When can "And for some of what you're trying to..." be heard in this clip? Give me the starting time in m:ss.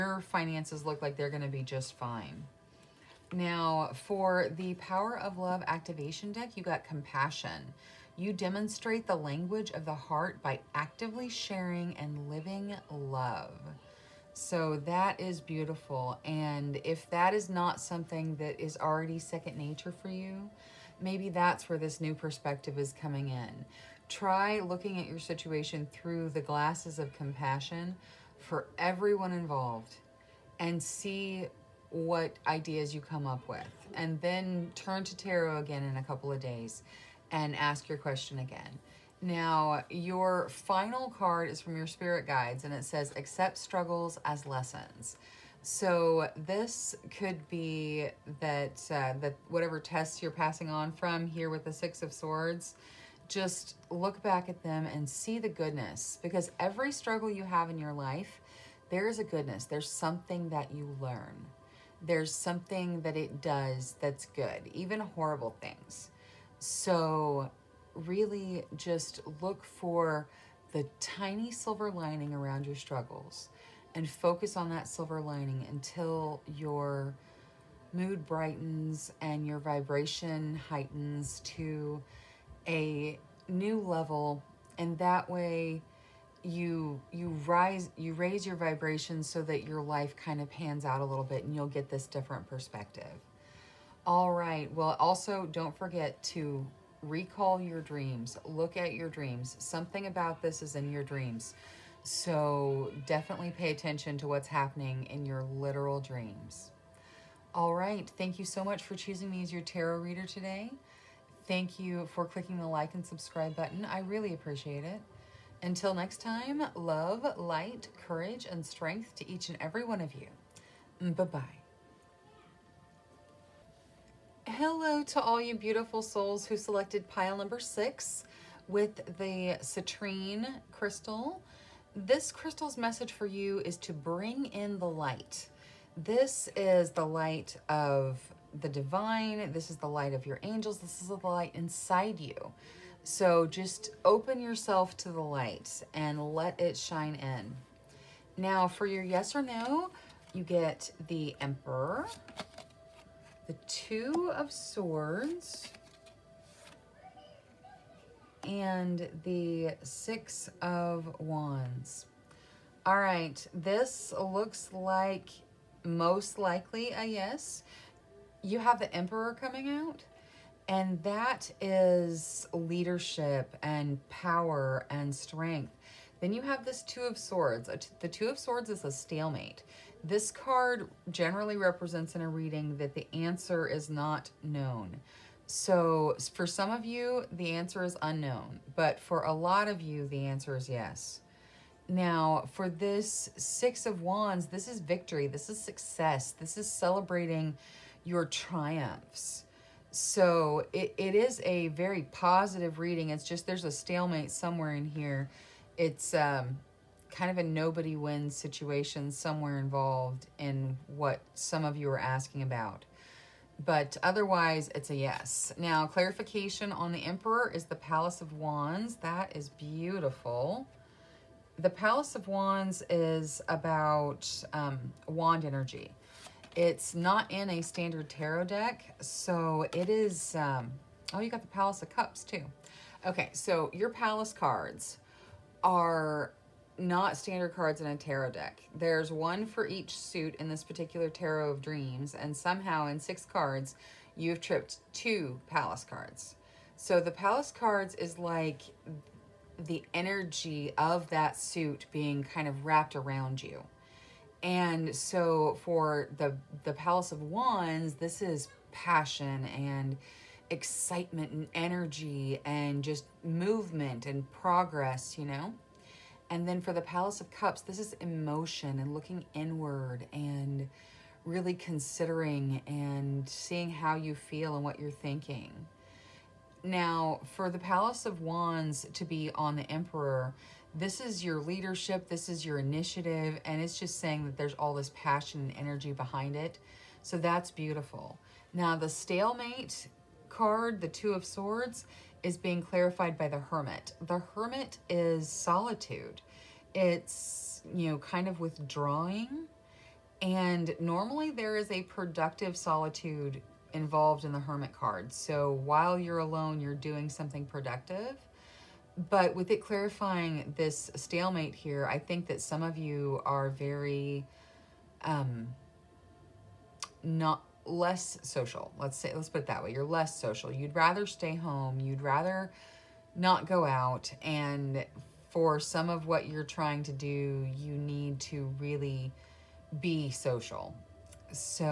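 5:24.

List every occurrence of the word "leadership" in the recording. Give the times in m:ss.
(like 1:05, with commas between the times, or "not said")
2:52, 4:41.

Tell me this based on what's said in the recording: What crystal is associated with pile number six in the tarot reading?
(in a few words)
citrine.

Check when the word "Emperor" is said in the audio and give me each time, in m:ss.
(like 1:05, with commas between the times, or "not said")
2:31, 2:48, 3:37, 4:39.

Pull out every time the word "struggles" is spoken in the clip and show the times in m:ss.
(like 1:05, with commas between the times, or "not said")
0:43, 0:56, 1:12.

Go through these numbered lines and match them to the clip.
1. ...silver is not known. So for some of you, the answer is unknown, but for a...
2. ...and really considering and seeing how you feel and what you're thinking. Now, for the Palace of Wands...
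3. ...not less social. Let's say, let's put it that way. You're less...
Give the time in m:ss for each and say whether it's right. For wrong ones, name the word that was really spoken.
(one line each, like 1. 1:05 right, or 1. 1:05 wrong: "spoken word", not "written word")
1. 3:03 wrong: "answer", not "silver"
2. 4:30 right
3. 5:17 right.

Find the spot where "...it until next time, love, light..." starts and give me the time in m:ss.
1:54.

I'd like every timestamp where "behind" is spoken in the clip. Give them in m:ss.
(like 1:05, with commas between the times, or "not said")
4:45.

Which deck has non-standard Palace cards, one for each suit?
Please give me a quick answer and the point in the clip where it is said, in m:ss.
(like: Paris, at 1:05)
Tarot of Dreams, at 4:01.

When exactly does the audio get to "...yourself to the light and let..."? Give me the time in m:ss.
2:24.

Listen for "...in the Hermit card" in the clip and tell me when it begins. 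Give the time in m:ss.
5:04.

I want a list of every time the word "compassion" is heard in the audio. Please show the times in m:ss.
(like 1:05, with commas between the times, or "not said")
0:06, 0:27.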